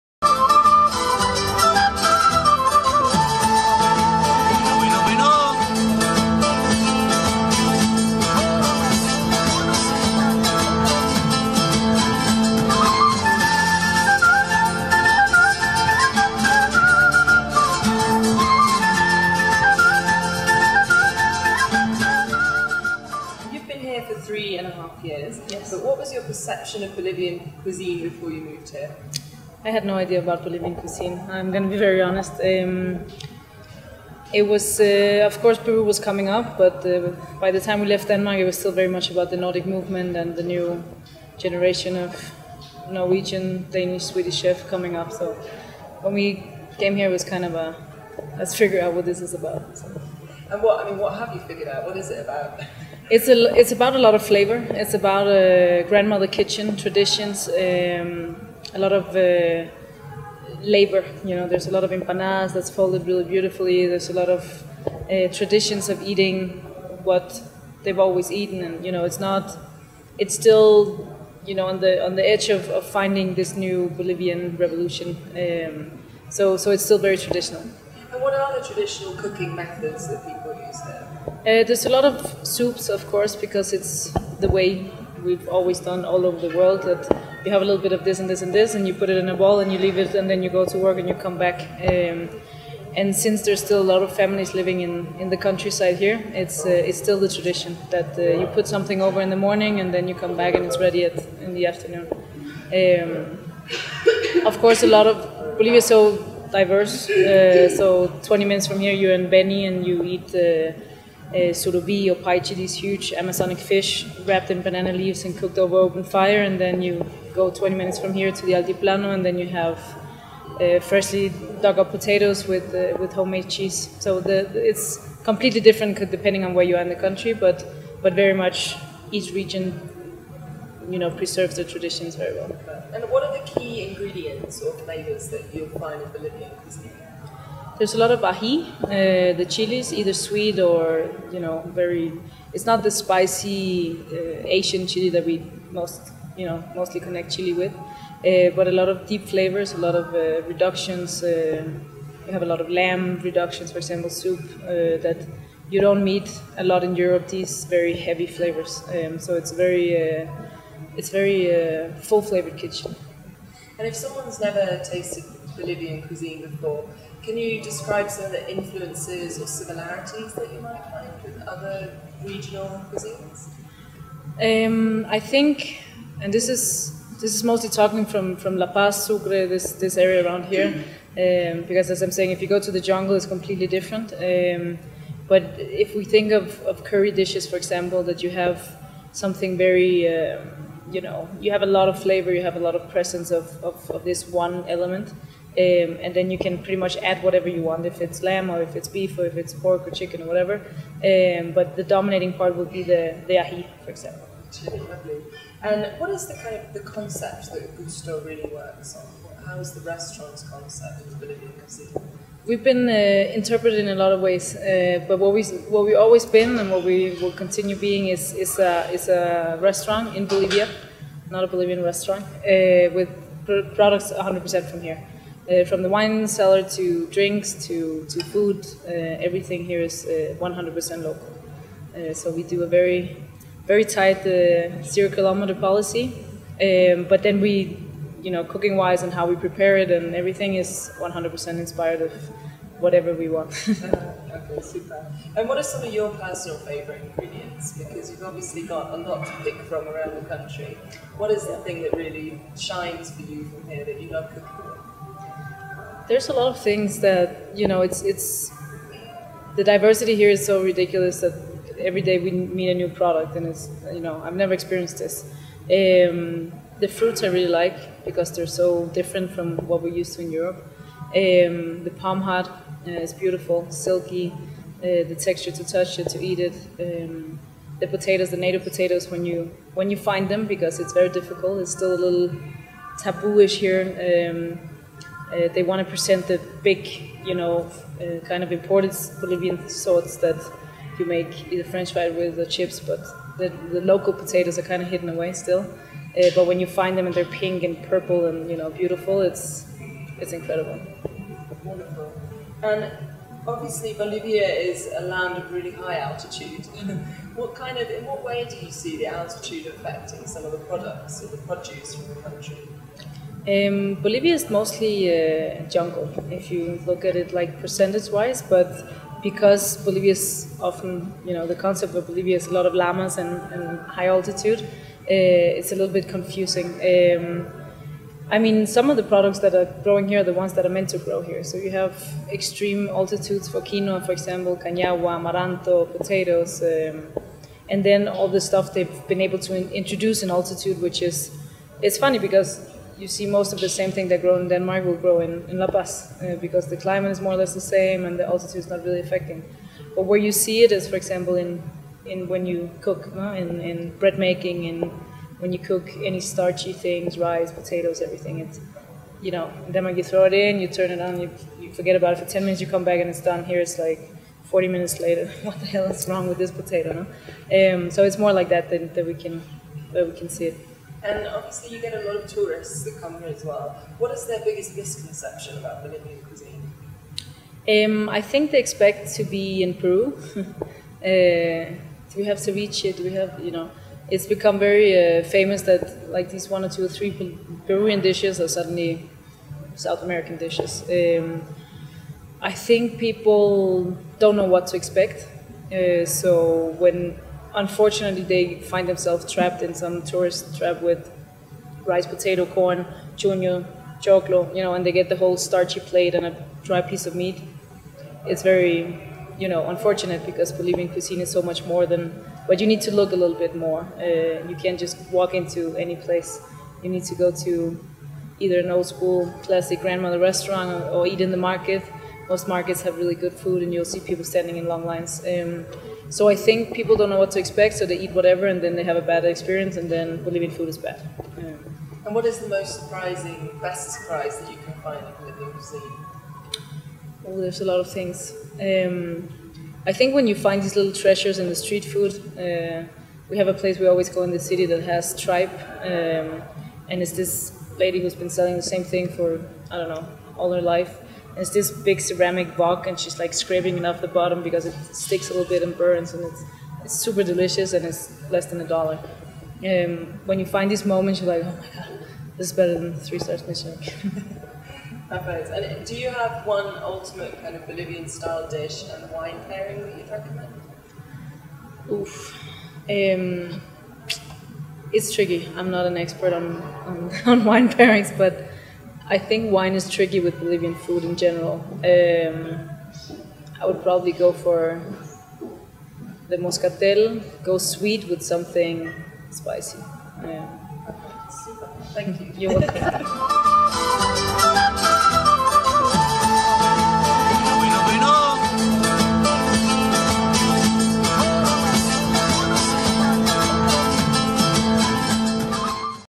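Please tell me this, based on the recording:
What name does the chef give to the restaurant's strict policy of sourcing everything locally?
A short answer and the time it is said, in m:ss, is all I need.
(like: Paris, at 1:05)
Zero kilometer policy, at 3:54.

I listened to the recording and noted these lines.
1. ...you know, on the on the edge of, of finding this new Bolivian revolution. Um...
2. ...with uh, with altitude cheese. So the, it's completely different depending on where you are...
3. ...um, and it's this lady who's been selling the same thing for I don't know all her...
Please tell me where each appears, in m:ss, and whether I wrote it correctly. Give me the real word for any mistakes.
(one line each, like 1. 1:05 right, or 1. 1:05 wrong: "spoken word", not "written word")
1. 1:11 right
2. 2:02 wrong: "homemade", not "altitude"
3. 7:25 right.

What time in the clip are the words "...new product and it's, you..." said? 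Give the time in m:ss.
4:22.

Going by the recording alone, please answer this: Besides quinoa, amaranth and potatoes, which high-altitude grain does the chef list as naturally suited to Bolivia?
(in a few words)
Cañagua.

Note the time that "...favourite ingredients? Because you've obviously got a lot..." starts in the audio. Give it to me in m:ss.
4:06.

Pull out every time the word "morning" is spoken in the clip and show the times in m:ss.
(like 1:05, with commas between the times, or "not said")
1:39.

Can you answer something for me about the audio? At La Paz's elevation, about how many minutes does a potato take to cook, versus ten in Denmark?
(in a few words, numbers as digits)
40 minutes.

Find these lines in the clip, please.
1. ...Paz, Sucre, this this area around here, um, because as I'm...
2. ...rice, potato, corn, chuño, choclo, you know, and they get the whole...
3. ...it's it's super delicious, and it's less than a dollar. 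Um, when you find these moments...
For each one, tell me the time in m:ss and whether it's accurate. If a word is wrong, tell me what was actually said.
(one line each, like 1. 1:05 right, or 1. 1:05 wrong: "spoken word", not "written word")
1. 2:58 right
2. 6:41 right
3. 7:36 right.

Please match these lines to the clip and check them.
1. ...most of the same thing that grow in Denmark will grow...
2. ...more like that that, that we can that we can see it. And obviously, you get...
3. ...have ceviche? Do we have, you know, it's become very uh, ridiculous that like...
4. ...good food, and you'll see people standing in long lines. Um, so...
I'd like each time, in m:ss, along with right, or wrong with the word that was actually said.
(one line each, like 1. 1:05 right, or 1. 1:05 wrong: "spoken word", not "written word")
1. 5:43 right
2. 6:08 right
3. 6:22 wrong: "famous", not "ridiculous"
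4. 7:03 right.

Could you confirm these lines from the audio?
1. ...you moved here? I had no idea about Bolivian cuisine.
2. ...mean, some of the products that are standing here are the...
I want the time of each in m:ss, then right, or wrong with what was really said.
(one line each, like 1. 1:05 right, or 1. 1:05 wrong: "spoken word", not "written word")
1. 0:28 right
2. 5:28 wrong: "growing", not "standing".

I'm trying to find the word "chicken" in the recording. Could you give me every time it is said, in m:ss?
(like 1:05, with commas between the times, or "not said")
3:19.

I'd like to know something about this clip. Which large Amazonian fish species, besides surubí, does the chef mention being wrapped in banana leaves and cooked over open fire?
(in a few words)
Paiche.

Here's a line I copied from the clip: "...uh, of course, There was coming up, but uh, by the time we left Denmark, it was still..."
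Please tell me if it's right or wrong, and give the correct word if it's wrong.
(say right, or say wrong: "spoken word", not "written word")
wrong: "Peru", not "There".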